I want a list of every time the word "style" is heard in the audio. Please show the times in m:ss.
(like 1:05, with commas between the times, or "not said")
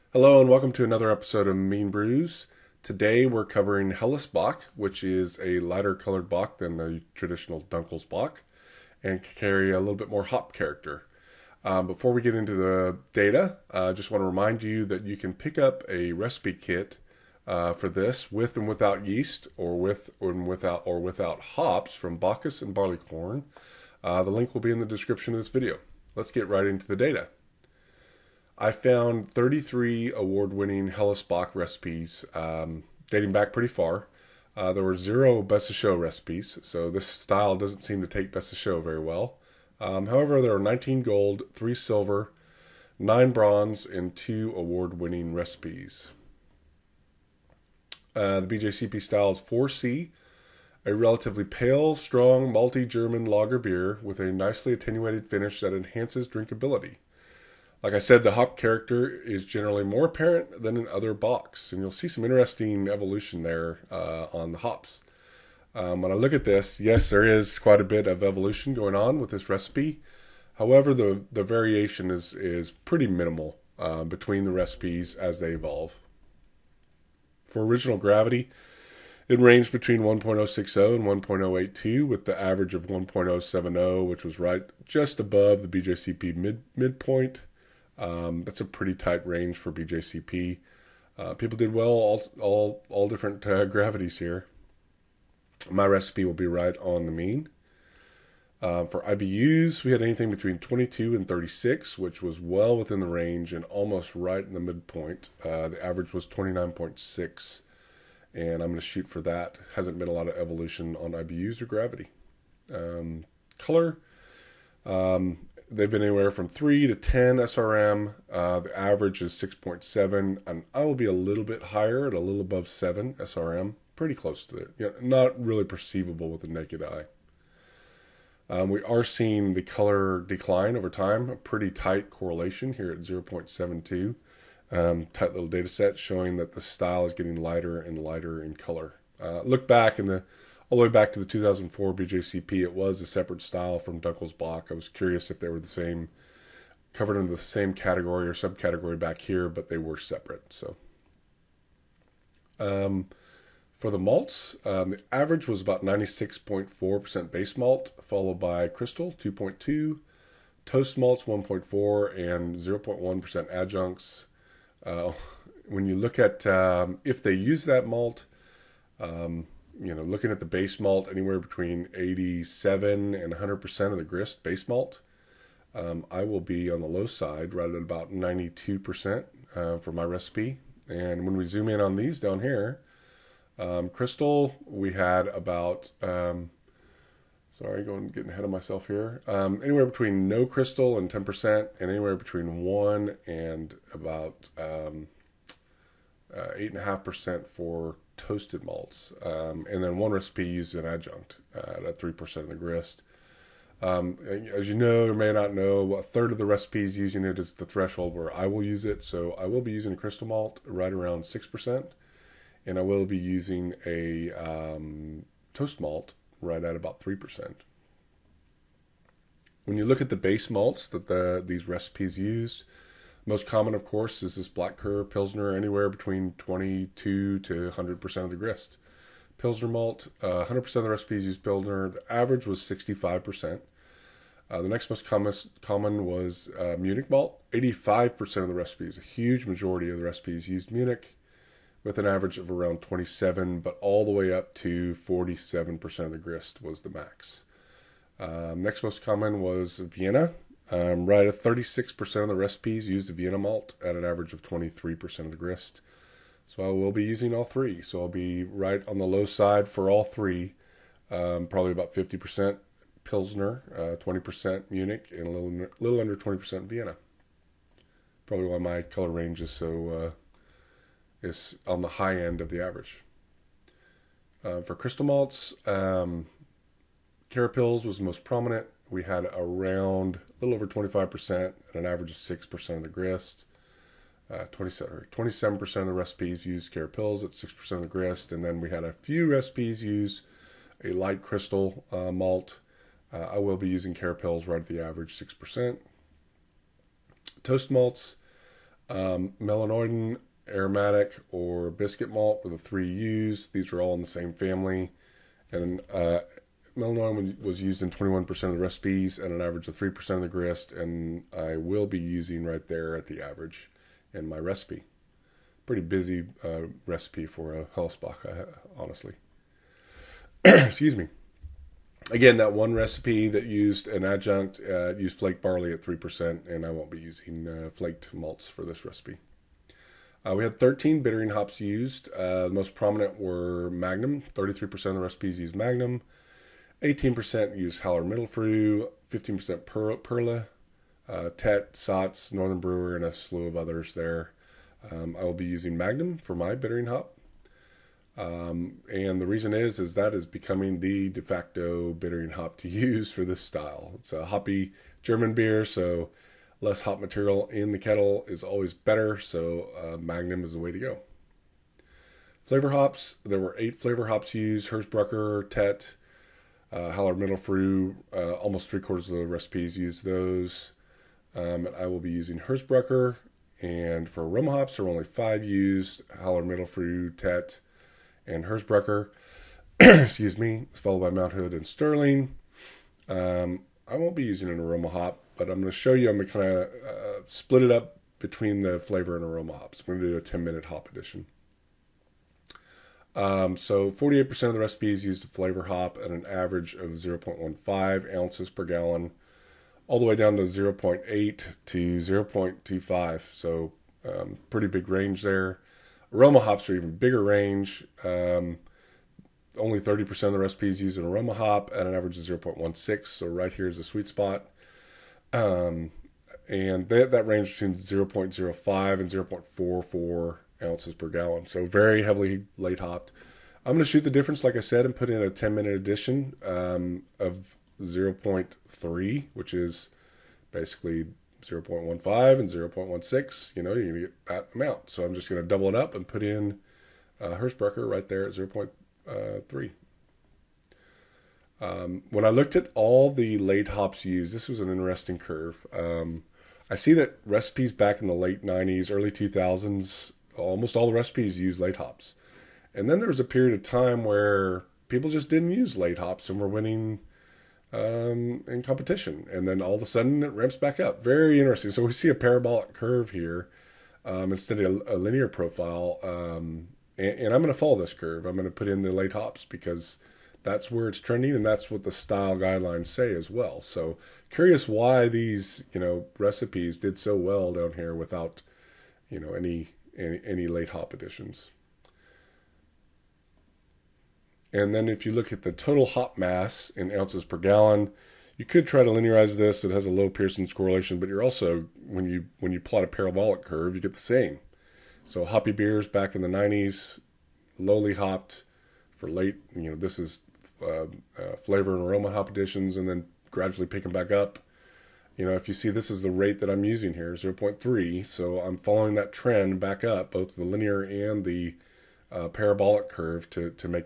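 0:37, 0:49, 2:16, 2:23, 5:53, 7:51.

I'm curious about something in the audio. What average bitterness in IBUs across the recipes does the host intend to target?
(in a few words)
29.6.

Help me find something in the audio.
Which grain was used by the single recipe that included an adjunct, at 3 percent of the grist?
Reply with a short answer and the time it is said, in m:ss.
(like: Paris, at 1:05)
flaked barley, at 5:25.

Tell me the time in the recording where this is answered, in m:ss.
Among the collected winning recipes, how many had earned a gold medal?
0:40.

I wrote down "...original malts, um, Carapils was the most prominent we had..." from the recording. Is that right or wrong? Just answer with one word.
wrong.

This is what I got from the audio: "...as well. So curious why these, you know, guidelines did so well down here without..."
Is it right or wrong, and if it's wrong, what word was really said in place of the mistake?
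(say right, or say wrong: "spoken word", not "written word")
wrong: "recipes", not "guidelines".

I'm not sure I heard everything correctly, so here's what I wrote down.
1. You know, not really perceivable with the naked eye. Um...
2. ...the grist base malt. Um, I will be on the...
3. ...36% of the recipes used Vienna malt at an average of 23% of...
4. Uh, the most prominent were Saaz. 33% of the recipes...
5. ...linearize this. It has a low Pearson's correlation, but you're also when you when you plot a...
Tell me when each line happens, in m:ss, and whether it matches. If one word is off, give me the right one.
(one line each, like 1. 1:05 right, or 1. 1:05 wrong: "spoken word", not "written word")
1. 2:04 right
2. 2:53 right
3. 4:11 right
4. 5:32 wrong: "Magnum", not "Saaz"
5. 8:08 right.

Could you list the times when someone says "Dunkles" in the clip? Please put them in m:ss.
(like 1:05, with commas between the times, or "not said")
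0:07, 2:24.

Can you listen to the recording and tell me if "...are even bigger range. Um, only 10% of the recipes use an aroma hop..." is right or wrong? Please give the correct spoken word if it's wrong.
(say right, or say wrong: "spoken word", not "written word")
wrong: "30", not "10".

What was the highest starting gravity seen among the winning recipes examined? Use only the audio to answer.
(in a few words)
1.082.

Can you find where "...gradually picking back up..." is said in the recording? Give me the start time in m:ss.
8:23.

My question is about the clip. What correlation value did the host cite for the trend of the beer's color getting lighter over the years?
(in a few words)
0.72.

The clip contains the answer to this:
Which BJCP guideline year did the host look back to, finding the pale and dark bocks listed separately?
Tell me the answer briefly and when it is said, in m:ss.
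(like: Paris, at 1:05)
2004, at 2:21.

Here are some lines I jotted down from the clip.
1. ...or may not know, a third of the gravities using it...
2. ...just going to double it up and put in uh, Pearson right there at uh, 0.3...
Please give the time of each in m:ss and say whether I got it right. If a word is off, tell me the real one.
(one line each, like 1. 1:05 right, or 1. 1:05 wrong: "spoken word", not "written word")
1. 3:25 wrong: "recipes", not "gravities"
2. 7:15 wrong: "Hersbrucker", not "Pearson".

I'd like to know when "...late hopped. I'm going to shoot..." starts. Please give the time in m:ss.
7:02.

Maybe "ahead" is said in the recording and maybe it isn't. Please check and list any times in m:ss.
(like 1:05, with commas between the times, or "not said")
3:08.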